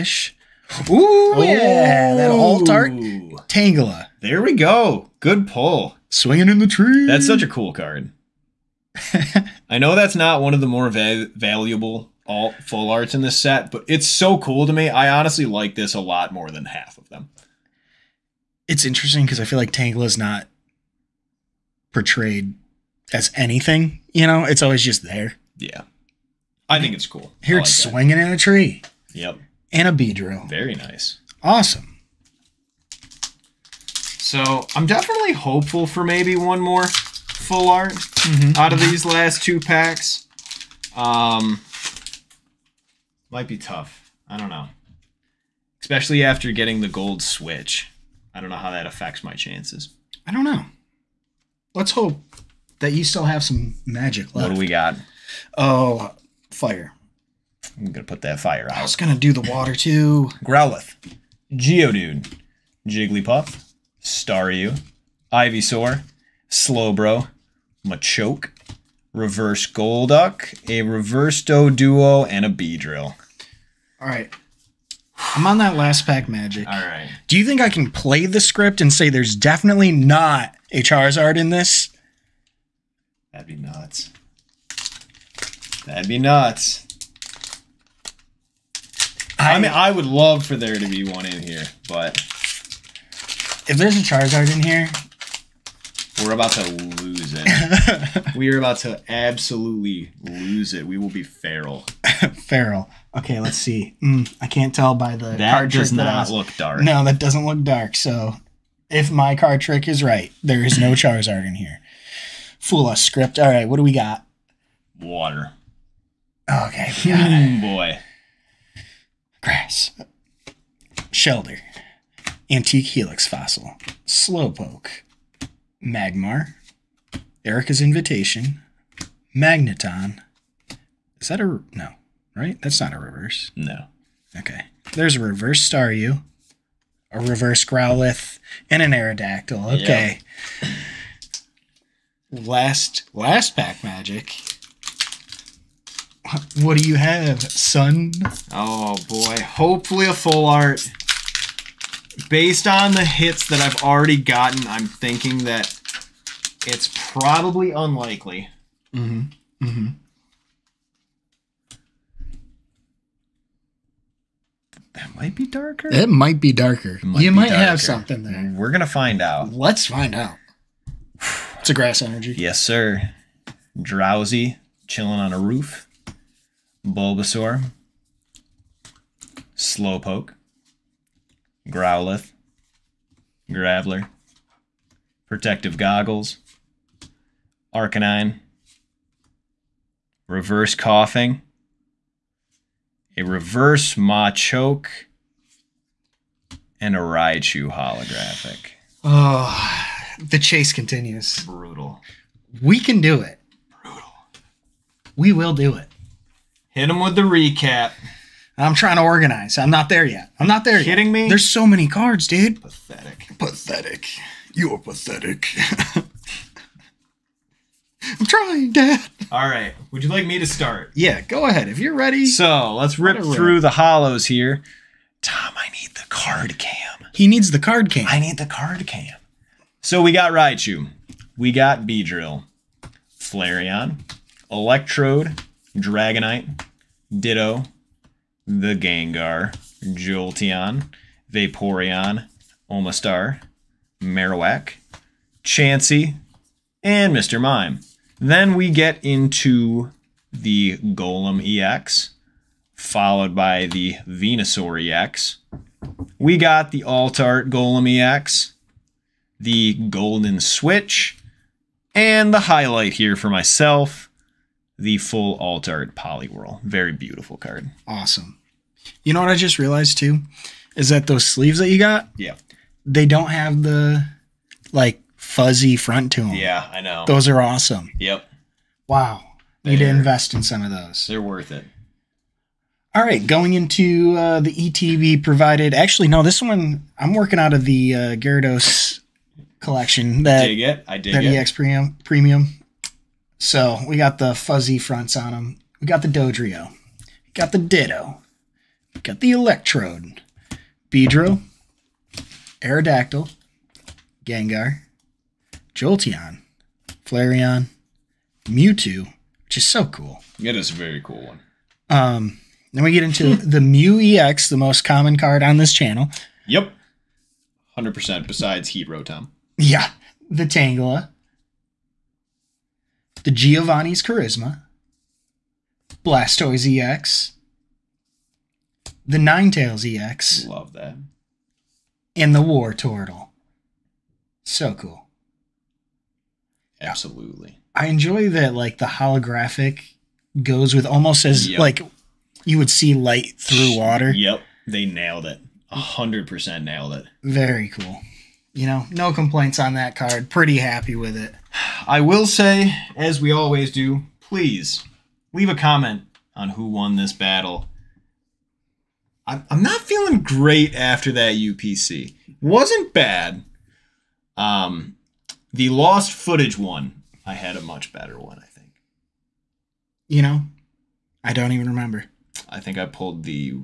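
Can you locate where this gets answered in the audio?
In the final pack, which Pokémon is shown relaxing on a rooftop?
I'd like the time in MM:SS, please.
02:53.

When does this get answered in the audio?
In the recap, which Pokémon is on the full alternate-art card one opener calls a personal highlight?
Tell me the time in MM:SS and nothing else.
04:25.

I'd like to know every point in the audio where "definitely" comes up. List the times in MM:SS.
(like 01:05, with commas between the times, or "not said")
00:34, 01:19.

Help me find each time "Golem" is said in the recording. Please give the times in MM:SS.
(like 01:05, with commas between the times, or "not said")
04:10, 04:17.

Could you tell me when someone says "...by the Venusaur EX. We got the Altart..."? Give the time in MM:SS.
04:13.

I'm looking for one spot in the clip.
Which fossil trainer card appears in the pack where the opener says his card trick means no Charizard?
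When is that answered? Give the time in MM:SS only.
02:02.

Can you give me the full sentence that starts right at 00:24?
You know, it's always just there.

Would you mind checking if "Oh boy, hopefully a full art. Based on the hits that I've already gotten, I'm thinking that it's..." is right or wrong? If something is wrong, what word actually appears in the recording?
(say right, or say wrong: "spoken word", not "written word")
right.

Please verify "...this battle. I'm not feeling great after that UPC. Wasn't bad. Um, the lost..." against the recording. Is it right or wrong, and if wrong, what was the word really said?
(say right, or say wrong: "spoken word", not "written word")
right.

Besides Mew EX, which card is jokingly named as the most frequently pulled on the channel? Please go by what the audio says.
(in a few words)
Heat Rotom.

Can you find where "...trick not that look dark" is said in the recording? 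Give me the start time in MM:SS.
01:45.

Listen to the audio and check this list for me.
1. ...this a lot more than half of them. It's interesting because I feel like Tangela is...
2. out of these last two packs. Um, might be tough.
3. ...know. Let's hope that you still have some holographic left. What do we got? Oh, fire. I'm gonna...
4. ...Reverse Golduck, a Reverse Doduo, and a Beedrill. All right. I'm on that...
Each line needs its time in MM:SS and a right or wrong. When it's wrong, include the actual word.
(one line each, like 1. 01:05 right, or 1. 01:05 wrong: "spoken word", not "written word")
1. 00:15 right
2. 00:38 right
3. 00:50 wrong: "magic", not "holographic"
4. 01:09 right.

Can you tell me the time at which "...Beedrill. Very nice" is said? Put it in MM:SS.
00:29.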